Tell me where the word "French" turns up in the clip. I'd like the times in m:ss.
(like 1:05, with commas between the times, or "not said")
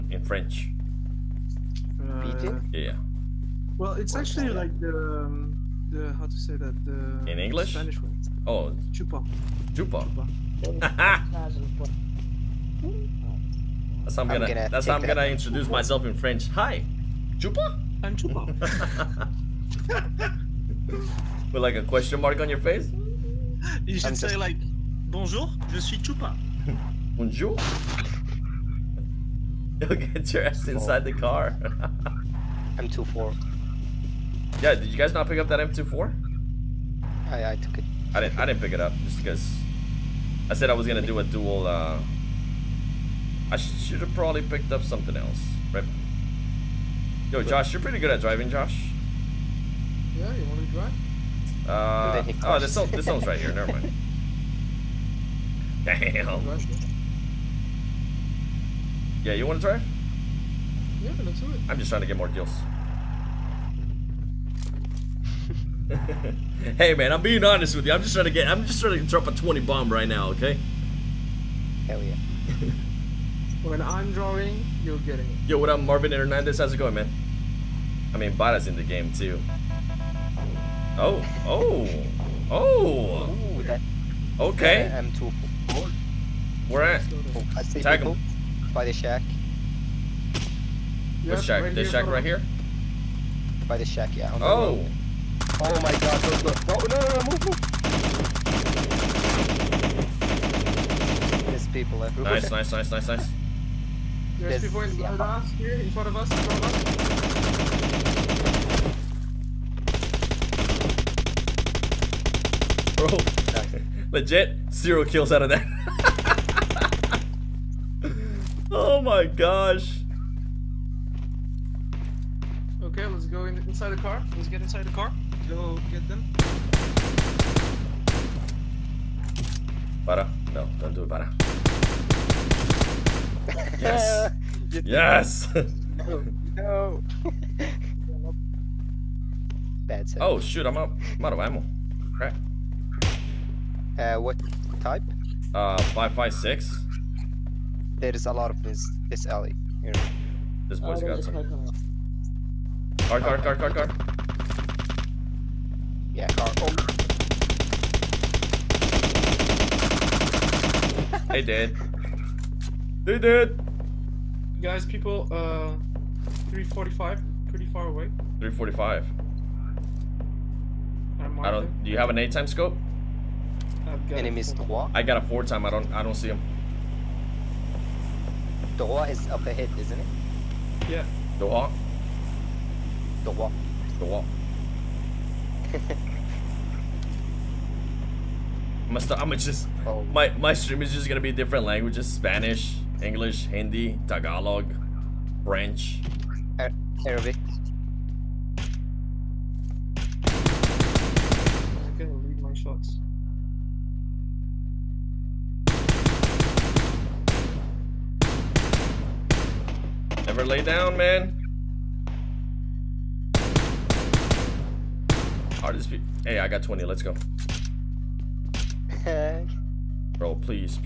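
0:00, 0:16, 3:15.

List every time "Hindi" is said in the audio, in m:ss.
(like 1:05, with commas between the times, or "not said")
3:13.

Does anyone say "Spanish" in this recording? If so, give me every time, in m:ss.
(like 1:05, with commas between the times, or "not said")
0:07, 3:12.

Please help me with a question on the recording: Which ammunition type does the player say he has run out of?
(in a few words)
5.56.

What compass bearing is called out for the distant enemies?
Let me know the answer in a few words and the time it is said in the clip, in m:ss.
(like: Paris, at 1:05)
345, at 2:46.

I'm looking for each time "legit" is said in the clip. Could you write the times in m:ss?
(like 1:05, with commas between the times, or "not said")
1:54.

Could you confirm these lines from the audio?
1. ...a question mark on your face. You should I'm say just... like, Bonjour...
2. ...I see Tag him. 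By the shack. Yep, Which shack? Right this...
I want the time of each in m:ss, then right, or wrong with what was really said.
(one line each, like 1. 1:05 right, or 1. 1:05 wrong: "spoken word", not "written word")
1. 0:21 right
2. 1:27 right.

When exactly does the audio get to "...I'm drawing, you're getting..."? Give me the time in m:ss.
1:13.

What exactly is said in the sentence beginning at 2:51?
Do you have an eight time scope?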